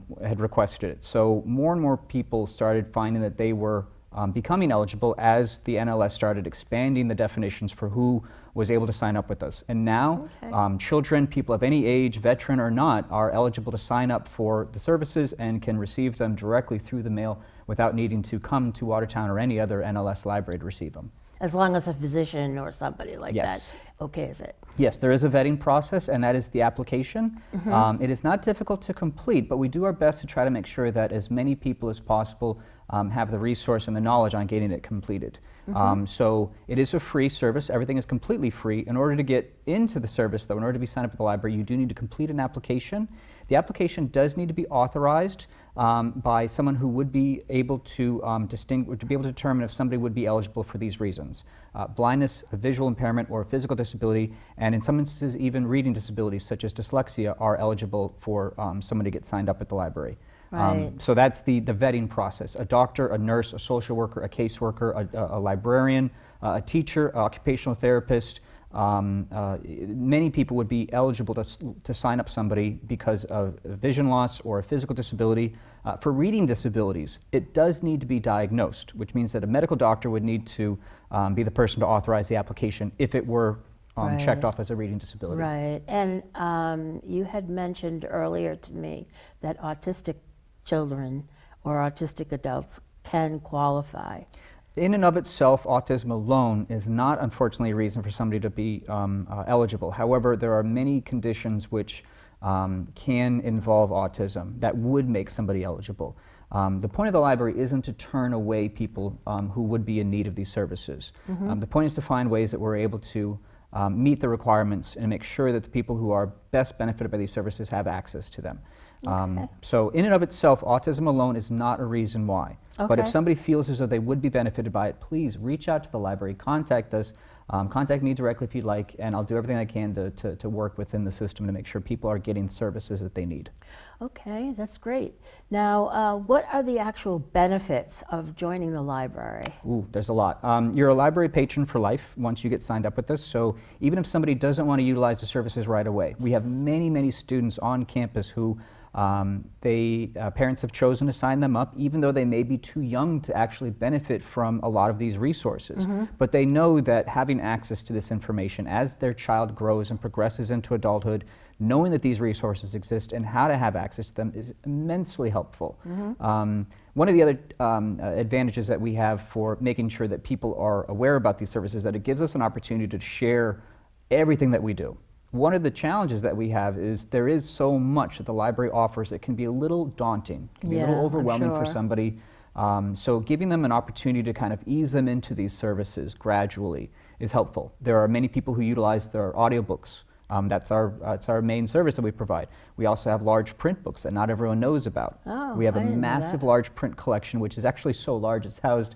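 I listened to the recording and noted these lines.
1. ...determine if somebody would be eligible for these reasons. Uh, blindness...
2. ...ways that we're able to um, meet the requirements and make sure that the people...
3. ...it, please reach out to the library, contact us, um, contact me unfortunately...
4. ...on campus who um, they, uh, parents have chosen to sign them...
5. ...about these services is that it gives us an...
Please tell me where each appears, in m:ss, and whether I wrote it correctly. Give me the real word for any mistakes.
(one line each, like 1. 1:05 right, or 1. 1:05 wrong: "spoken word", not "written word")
1. 0:49 right
2. 1:52 right
3. 2:04 wrong: "directly", not "unfortunately"
4. 2:27 right
5. 2:51 right.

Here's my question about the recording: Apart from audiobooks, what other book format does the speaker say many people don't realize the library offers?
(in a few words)
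large print books.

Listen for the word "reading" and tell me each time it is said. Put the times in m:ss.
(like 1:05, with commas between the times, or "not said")
0:55, 1:16, 1:24.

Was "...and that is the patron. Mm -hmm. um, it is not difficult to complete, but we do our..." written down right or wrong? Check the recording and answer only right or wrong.
wrong.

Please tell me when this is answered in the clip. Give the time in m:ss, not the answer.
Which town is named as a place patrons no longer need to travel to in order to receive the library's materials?
0:18.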